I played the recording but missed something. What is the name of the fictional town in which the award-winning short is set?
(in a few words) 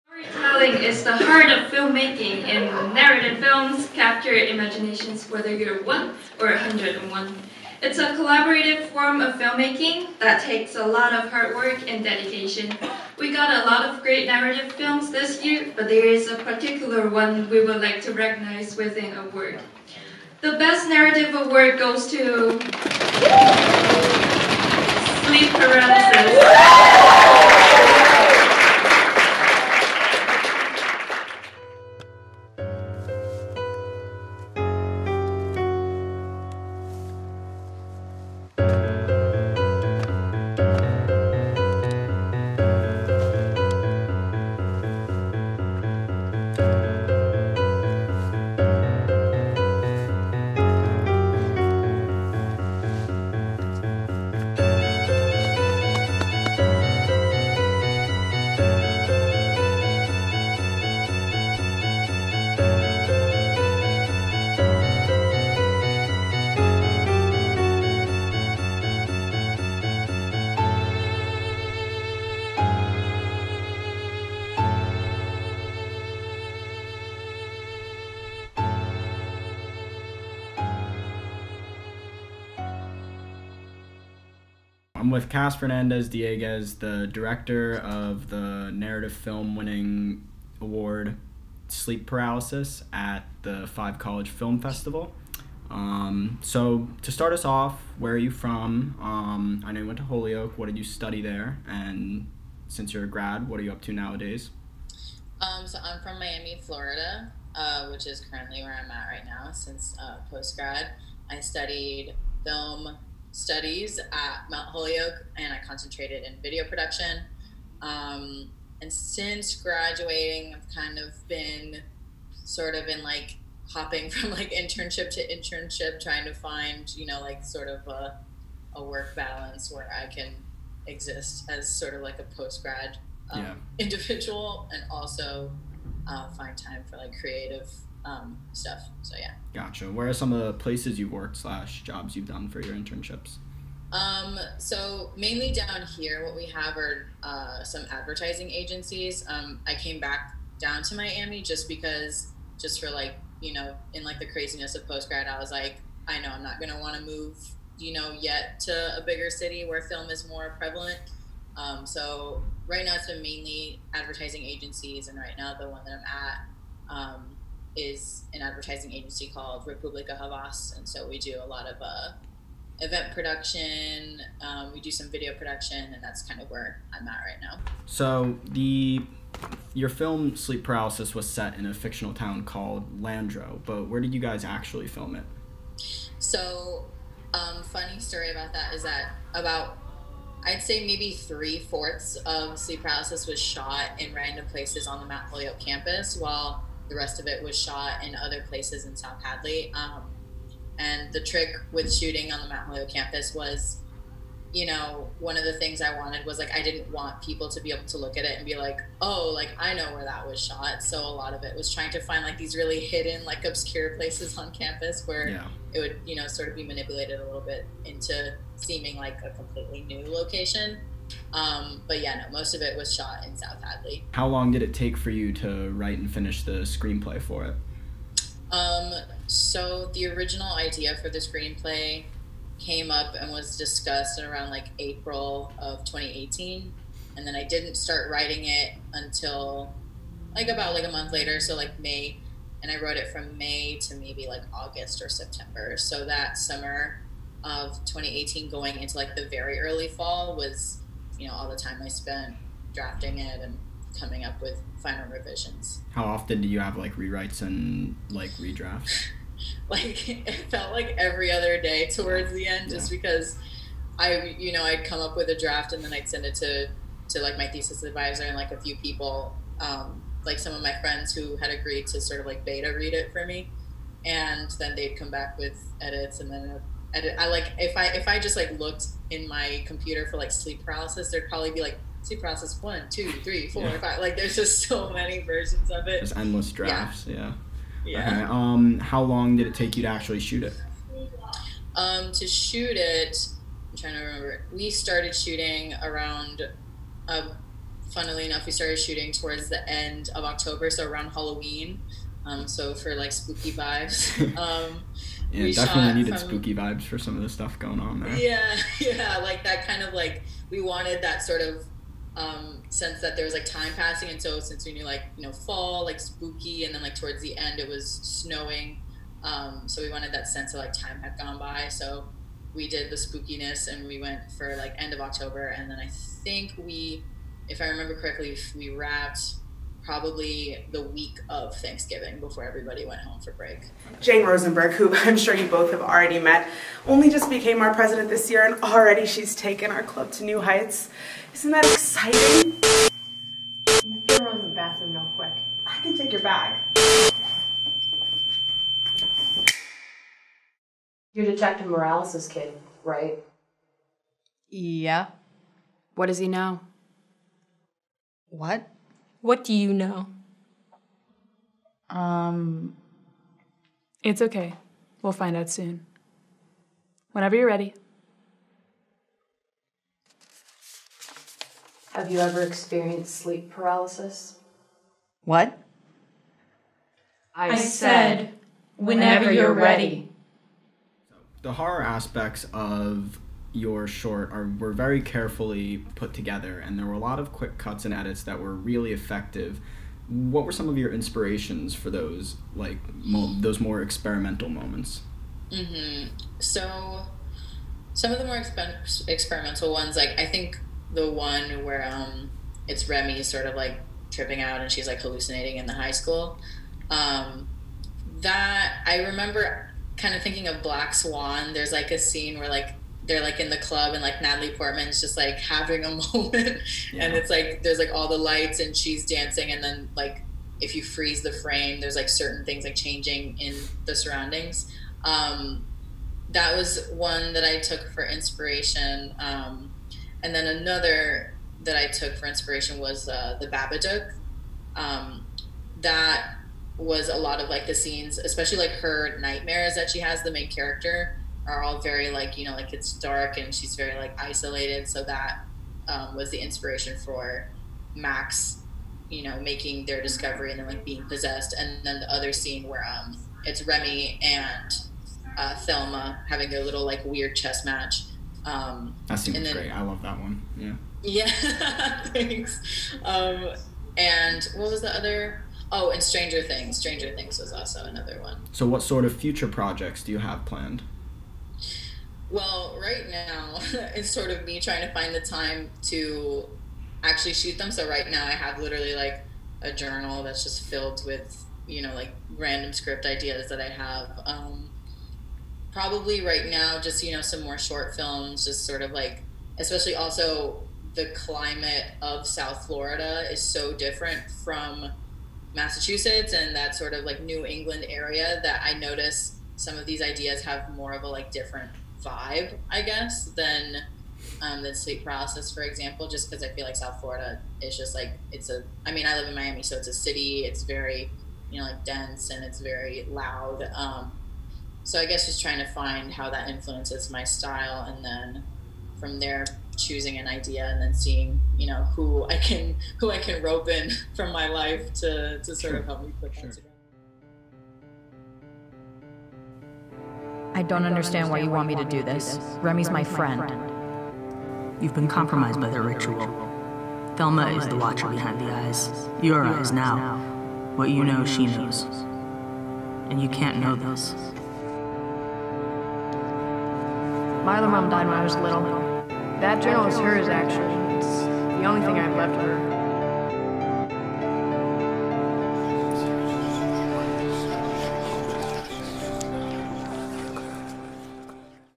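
Landro.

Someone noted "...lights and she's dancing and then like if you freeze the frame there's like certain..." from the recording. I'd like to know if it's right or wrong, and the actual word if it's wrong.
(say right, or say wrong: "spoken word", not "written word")
right.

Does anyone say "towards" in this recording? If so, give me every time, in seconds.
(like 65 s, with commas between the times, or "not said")
261 s, 299 s, 316 s.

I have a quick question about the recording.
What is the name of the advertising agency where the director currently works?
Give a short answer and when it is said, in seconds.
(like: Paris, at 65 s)
Republica Havas, at 169 s.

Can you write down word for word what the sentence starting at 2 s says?
In narrative films, capture imaginations whether you're one or 101.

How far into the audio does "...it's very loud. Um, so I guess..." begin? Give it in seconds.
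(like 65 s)
512 s.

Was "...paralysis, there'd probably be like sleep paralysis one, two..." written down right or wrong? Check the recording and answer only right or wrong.
right.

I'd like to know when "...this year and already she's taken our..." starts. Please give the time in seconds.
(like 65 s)
338 s.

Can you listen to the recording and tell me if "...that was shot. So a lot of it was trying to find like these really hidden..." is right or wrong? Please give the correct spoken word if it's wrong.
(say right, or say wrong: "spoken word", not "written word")
right.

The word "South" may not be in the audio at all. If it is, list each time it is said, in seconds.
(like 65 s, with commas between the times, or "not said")
198 s, 223 s, 492 s, 506 s.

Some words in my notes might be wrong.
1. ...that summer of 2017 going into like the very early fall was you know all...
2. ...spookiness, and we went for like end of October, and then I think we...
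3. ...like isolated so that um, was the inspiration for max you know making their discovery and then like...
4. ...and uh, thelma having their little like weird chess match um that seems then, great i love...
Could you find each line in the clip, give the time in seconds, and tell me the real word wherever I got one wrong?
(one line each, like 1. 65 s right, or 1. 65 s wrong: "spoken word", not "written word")
1. 246 s wrong: "2018", not "2017"
2. 322 s right
3. 443 s right
4. 454 s right.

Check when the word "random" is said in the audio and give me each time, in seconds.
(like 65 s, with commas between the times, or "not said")
194 s, 482 s.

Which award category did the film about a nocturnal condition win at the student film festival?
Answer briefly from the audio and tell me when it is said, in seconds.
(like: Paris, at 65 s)
Best Narrative Award, at 20 s.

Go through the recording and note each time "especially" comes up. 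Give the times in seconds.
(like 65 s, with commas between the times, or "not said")
438 s, 489 s.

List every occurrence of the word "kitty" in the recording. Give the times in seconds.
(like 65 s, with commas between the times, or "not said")
not said.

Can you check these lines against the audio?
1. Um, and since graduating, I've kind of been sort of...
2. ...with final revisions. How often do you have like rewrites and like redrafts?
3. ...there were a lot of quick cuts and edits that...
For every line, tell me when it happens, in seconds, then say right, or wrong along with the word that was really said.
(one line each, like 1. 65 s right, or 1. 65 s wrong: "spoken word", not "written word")
1. 117 s right
2. 254 s right
3. 386 s right.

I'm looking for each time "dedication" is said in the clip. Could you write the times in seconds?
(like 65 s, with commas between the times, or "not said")
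12 s.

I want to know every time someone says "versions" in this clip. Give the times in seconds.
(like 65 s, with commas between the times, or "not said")
285 s.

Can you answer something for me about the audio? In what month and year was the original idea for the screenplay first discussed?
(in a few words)
April 2018.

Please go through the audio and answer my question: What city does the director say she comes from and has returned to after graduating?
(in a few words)
Miami, Florida.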